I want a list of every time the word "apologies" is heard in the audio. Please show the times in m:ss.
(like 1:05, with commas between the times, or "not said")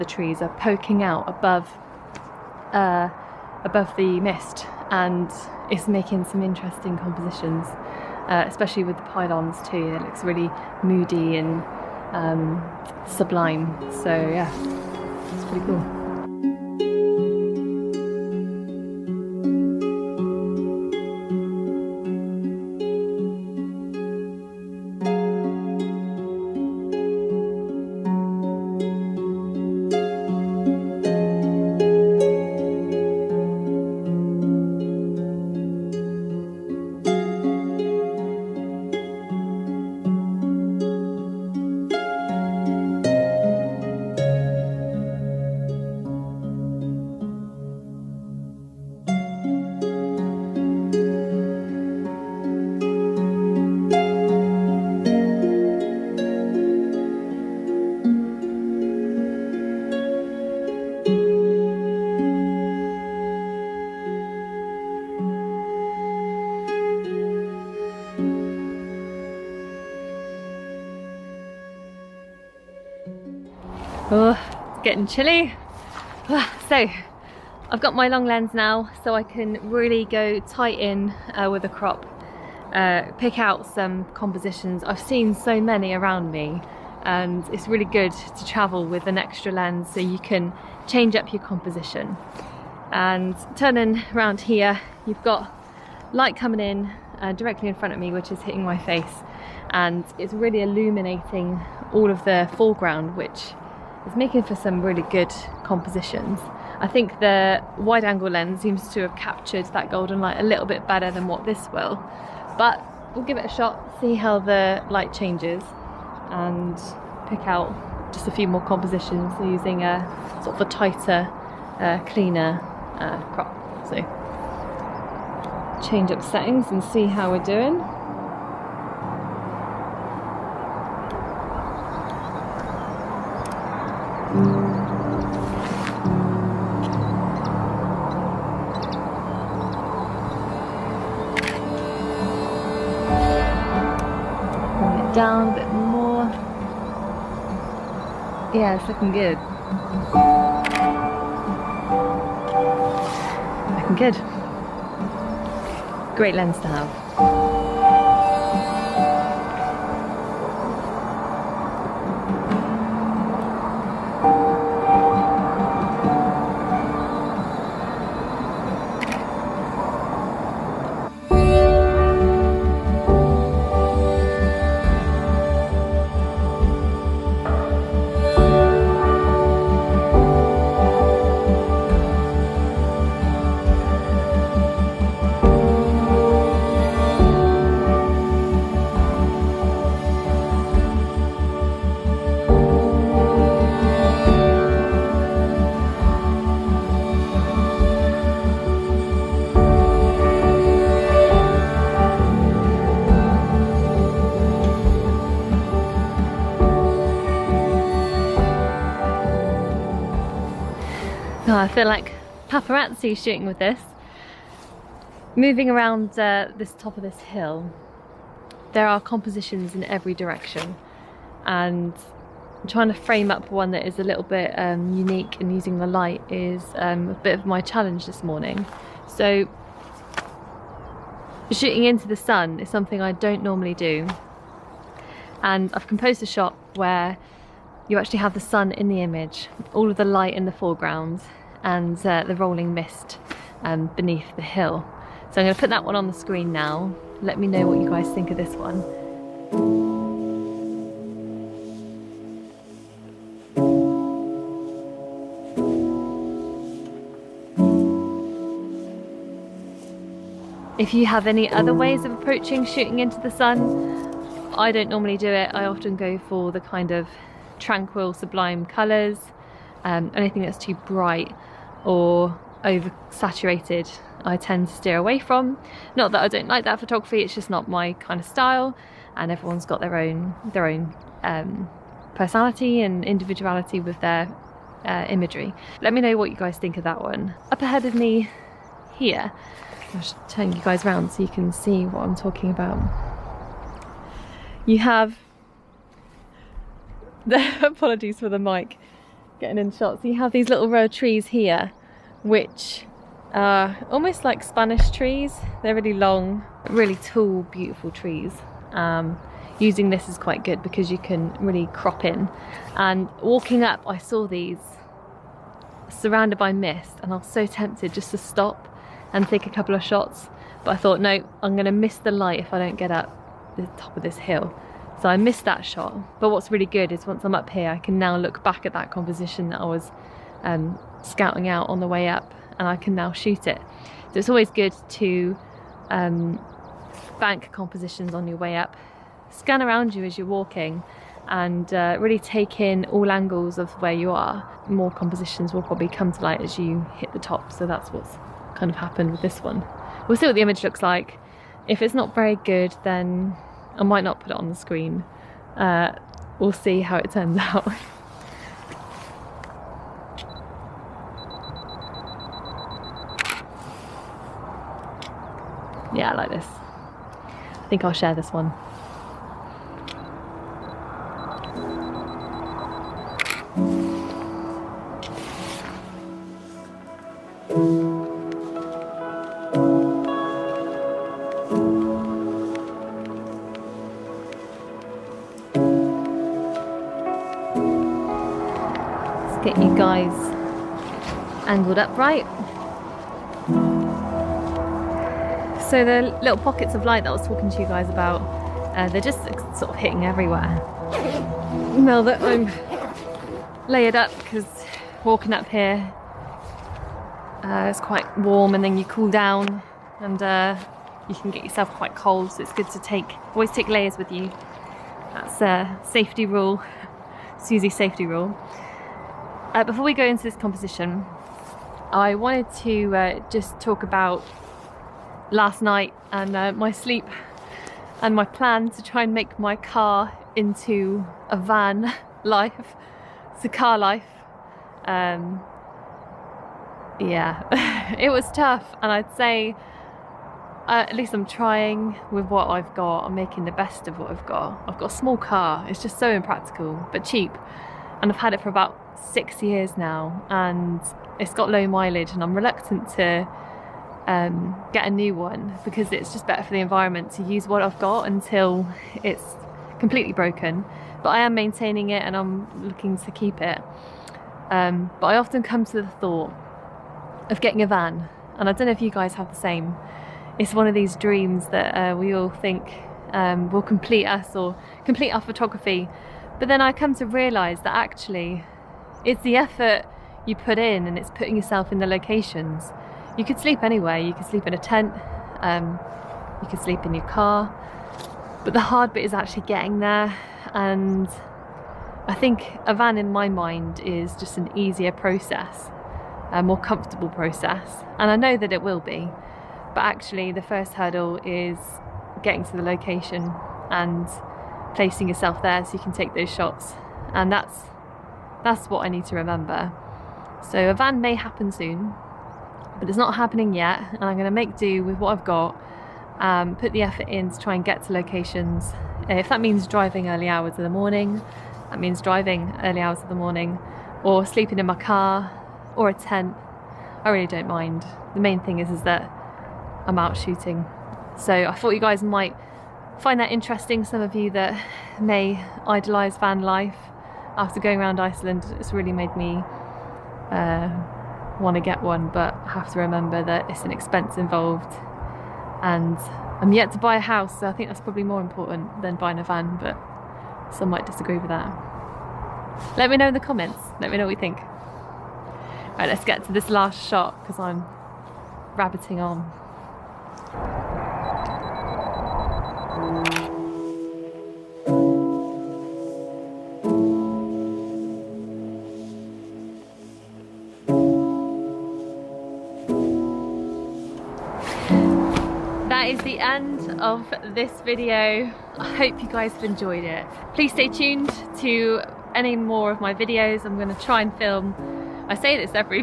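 4:57.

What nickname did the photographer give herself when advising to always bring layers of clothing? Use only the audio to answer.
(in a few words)
Susie safety rule.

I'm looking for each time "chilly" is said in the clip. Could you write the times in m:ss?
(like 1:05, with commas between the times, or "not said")
1:15.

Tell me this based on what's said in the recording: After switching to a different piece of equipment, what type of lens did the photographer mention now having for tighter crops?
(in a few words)
long lens.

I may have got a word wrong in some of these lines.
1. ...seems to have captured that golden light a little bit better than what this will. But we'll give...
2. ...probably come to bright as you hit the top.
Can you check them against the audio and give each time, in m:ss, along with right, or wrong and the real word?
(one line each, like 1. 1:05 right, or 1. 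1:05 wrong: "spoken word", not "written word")
1. 1:48 right
2. 5:45 wrong: "light", not "bright".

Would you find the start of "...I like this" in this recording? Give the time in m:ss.
6:06.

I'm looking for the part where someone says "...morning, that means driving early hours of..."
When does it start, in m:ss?
8:40.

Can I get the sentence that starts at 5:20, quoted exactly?
But I thought, no, I'm gonna miss the light if I don't get up the top of this hill.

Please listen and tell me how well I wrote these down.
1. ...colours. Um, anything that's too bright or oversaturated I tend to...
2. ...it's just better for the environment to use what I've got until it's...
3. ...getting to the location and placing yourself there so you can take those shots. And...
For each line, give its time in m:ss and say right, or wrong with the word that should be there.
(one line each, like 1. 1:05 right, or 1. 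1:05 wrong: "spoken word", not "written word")
1. 4:28 right
2. 7:35 right
3. 8:22 right.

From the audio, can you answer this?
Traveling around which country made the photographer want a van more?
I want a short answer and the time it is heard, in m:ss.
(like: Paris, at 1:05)
Iceland, at 8:57.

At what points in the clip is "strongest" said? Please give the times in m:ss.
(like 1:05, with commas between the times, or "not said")
not said.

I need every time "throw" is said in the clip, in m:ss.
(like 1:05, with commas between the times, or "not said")
not said.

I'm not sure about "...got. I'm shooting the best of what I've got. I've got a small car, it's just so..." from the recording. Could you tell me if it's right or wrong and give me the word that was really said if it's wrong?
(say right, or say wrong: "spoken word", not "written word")
wrong: "making", not "shooting".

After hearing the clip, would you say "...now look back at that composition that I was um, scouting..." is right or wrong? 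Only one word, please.
right.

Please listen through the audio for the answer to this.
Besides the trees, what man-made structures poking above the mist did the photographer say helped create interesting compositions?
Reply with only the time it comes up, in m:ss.
0:09.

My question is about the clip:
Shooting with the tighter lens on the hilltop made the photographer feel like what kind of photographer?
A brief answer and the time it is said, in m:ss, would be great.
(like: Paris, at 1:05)
paparazzi, at 3:32.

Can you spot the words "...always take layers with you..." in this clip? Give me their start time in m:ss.
6:53.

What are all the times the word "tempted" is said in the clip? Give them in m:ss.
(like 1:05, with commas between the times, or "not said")
5:17.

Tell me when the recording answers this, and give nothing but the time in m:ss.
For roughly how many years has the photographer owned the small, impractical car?
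7:29.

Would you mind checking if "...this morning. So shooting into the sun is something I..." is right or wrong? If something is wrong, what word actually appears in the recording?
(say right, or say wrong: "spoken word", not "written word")
right.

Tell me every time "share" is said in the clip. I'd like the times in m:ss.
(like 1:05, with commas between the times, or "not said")
6:07.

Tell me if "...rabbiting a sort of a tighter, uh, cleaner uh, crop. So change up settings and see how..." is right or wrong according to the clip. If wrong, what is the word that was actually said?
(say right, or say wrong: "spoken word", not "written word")
wrong: "using", not "rabbiting".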